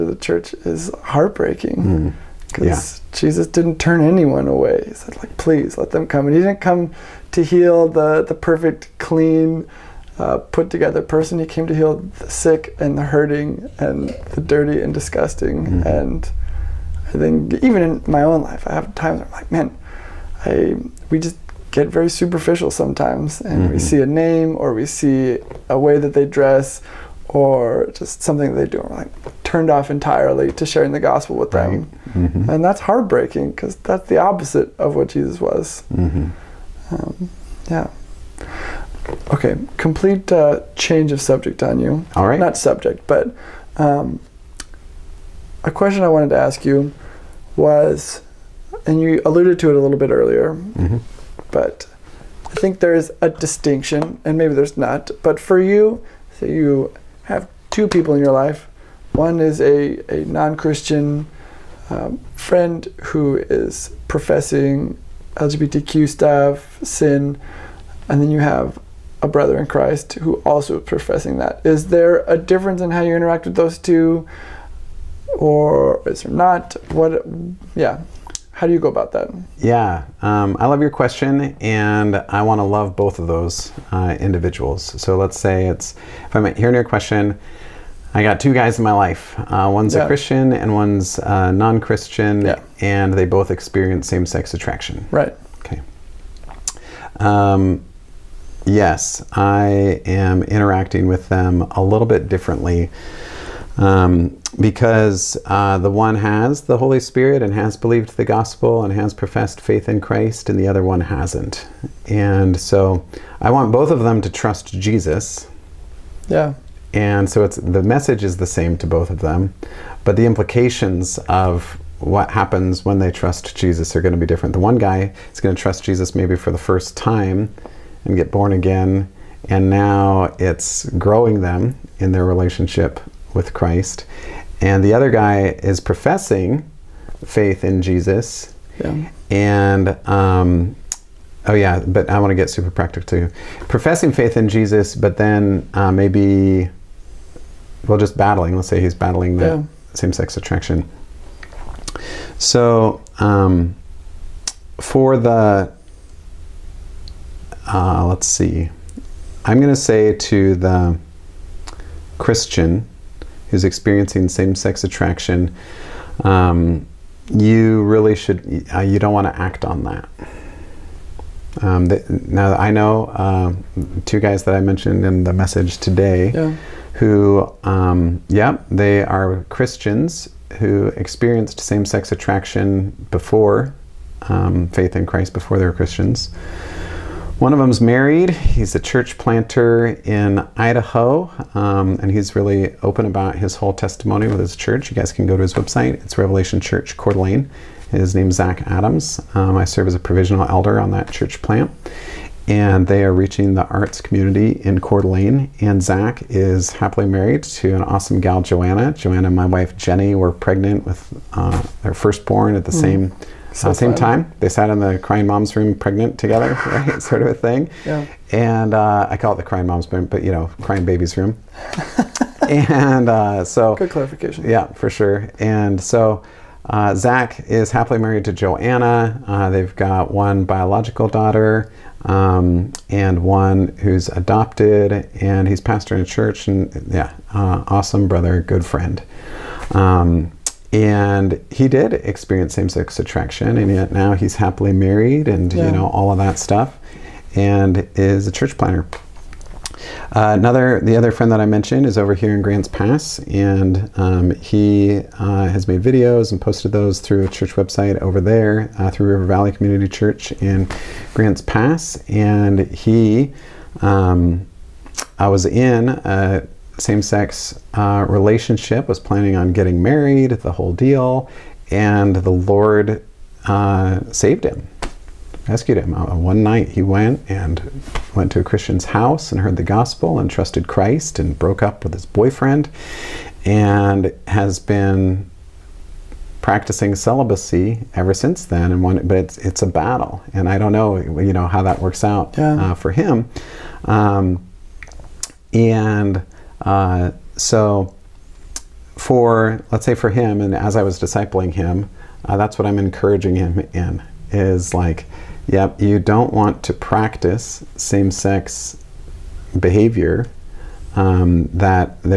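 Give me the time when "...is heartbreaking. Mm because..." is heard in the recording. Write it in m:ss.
0:00.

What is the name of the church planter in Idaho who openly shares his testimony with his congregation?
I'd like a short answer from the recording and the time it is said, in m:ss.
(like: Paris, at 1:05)
Zach Adams, at 3:18.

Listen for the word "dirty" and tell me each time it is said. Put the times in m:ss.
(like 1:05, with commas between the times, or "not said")
0:14.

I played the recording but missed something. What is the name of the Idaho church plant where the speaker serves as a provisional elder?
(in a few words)
Revelation Church Coeur d'Alene.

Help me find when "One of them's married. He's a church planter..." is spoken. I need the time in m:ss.
3:07.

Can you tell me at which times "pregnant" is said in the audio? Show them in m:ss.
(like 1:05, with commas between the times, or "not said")
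3:30, 3:35.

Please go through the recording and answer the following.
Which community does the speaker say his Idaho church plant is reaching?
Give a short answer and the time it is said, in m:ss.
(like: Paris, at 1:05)
the arts community, at 3:23.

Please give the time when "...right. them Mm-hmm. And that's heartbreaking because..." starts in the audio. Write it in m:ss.
0:31.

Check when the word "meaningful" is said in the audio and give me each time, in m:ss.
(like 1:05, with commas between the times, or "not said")
not said.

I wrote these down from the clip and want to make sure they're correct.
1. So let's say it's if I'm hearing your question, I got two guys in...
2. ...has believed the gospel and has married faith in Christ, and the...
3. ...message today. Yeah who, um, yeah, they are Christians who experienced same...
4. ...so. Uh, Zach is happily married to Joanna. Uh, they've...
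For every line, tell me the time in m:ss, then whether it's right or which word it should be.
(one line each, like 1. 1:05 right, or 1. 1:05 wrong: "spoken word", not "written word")
1. 1:25 right
2. 1:47 wrong: "professed", not "married"
3. 2:55 right
4. 3:45 right.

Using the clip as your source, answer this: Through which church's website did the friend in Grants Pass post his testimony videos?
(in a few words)
River Valley Community Church.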